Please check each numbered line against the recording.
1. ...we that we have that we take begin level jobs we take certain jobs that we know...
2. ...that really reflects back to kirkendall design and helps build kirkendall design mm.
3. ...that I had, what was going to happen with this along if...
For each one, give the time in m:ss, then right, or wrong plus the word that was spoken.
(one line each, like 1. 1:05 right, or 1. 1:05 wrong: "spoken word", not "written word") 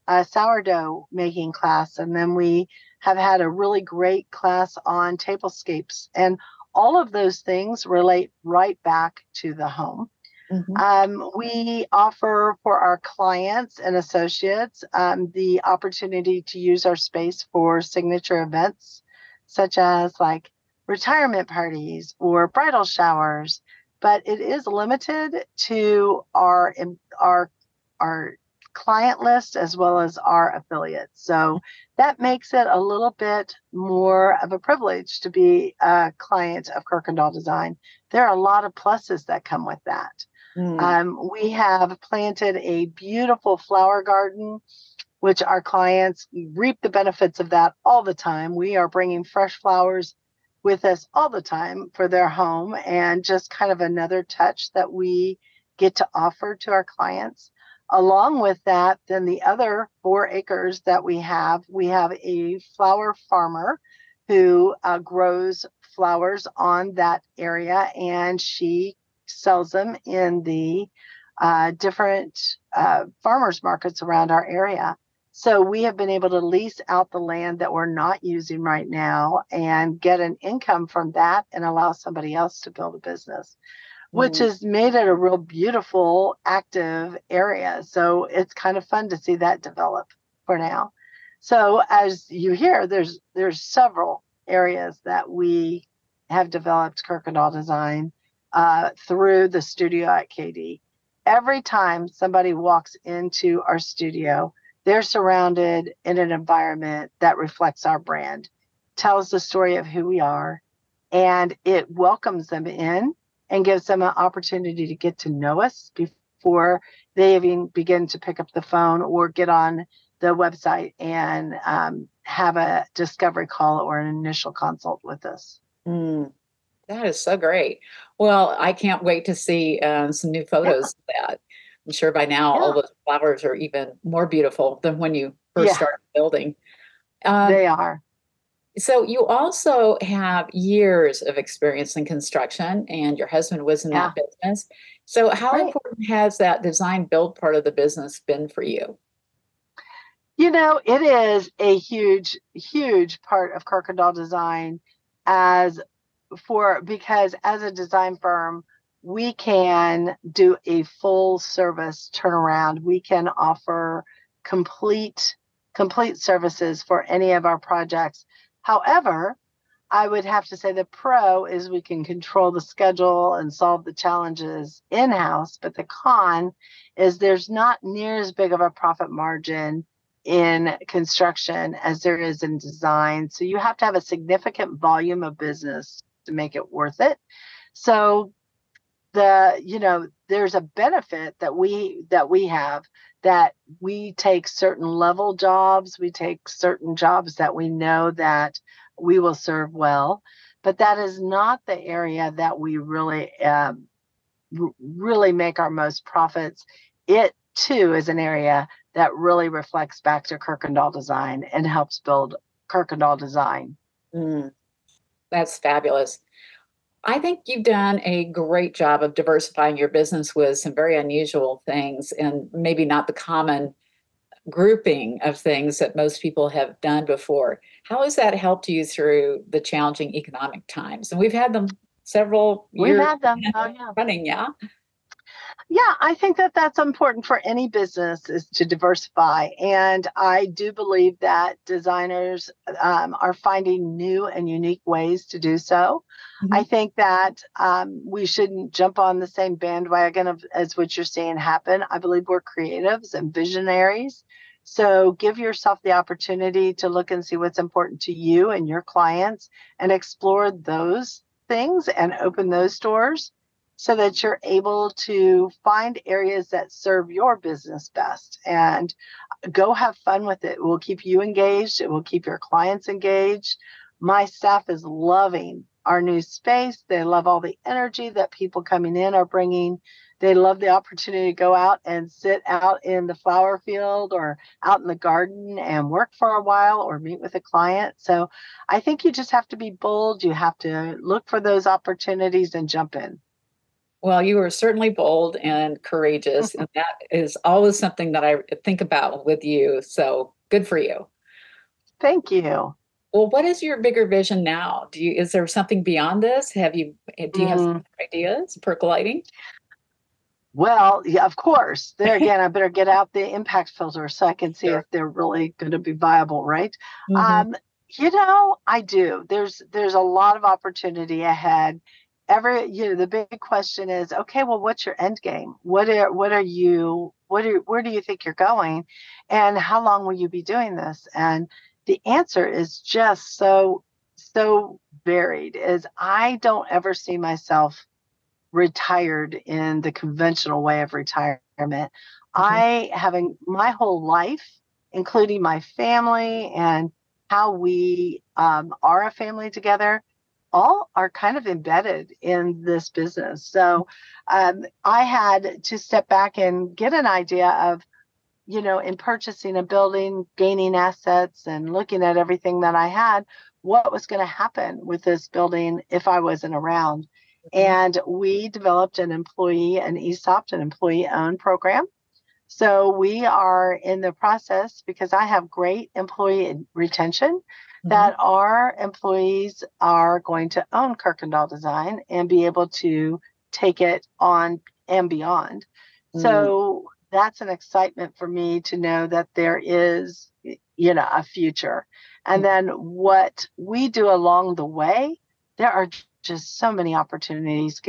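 1. 3:11 wrong: "certain", not "begin"
2. 3:28 right
3. 6:02 wrong: "building", not "along".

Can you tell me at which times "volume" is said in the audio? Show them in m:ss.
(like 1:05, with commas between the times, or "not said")
3:04.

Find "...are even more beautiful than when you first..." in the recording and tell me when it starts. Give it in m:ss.
2:13.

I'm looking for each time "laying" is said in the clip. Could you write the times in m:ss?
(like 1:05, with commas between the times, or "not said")
not said.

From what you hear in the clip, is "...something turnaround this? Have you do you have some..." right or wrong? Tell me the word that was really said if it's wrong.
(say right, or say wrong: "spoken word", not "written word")
wrong: "beyond", not "turnaround".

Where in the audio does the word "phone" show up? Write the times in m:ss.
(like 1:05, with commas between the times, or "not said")
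1:58.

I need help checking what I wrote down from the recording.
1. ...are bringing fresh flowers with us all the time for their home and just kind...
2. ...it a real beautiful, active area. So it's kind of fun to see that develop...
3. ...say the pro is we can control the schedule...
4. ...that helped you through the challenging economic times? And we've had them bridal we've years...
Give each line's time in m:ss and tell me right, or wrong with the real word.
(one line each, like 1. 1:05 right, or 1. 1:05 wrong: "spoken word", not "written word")
1. 0:48 right
2. 1:24 right
3. 2:50 right
4. 3:48 wrong: "several", not "bridal".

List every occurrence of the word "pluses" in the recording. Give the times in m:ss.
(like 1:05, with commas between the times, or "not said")
0:38.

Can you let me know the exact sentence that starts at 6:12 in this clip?
So we are in the process because I have great employee retention that mm-hmm.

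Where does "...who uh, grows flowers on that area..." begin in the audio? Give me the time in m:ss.
1:04.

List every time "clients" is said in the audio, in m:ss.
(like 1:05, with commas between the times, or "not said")
0:13, 0:28, 0:36, 0:45, 0:56, 4:18, 4:32, 4:47.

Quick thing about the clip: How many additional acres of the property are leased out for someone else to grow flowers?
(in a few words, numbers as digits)
4.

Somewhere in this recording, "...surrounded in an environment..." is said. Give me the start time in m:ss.
1:45.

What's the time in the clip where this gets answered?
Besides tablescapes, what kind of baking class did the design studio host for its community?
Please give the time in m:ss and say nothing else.
0:00.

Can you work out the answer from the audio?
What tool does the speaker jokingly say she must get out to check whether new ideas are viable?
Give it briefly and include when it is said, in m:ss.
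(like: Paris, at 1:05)
impact filter, at 5:13.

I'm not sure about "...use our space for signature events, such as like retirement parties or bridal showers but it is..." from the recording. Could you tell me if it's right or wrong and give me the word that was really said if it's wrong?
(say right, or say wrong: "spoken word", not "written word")
right.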